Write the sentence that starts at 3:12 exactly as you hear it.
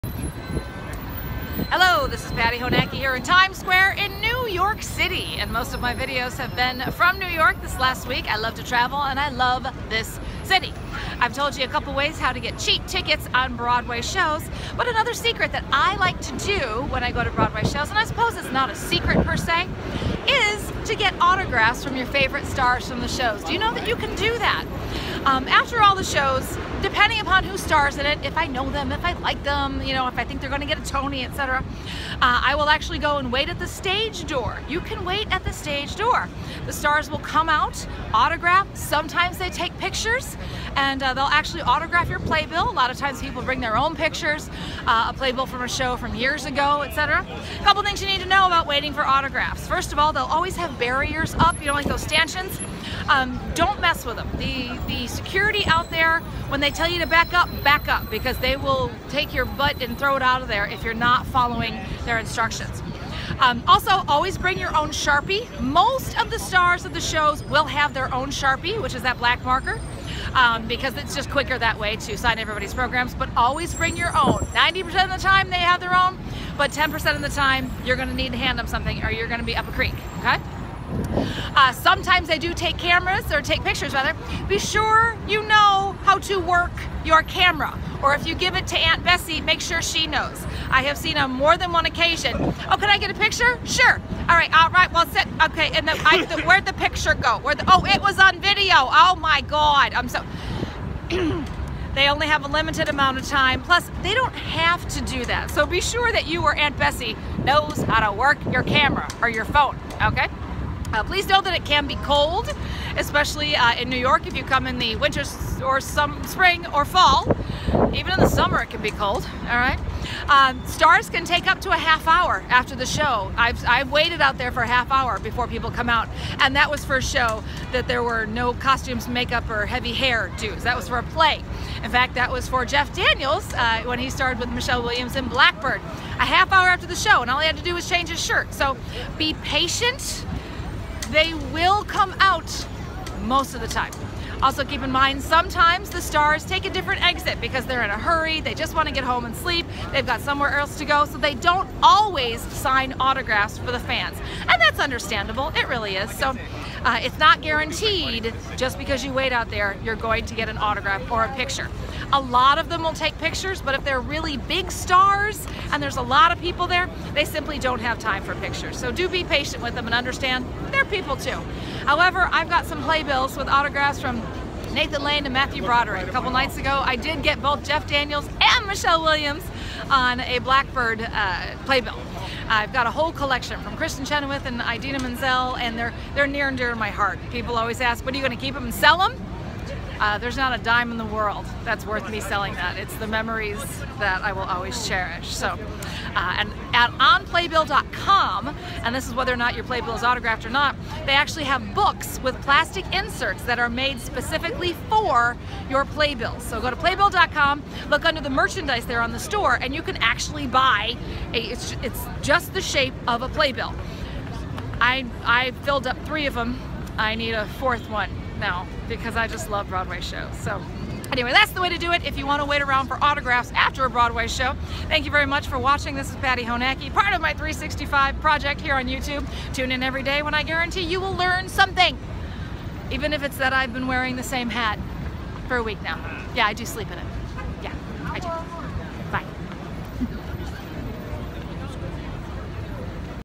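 It's the memories that I will always cherish.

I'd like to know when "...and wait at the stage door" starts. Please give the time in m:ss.
0:33.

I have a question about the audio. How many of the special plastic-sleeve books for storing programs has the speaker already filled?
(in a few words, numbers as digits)
3.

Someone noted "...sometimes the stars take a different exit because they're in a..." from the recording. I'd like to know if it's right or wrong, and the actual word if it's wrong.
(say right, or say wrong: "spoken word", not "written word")
right.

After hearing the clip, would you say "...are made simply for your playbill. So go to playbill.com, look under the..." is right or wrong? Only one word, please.
wrong.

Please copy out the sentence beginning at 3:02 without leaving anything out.
I've got a whole collection from Kristin Chenoweth and Idina Menzel, and they're they're near and dear to my heart.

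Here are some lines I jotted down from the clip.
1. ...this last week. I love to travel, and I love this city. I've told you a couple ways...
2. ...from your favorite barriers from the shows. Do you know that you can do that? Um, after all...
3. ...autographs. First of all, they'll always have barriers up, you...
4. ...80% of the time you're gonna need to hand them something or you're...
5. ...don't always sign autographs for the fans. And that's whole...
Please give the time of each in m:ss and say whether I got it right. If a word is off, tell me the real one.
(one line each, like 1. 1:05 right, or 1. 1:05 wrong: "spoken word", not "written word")
1. 0:07 right
2. 0:21 wrong: "stars", not "barriers"
3. 0:49 right
4. 1:16 wrong: "10", not "80"
5. 2:31 wrong: "understandable", not "whole".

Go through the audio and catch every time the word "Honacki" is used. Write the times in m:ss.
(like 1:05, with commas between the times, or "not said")
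0:02, 3:46.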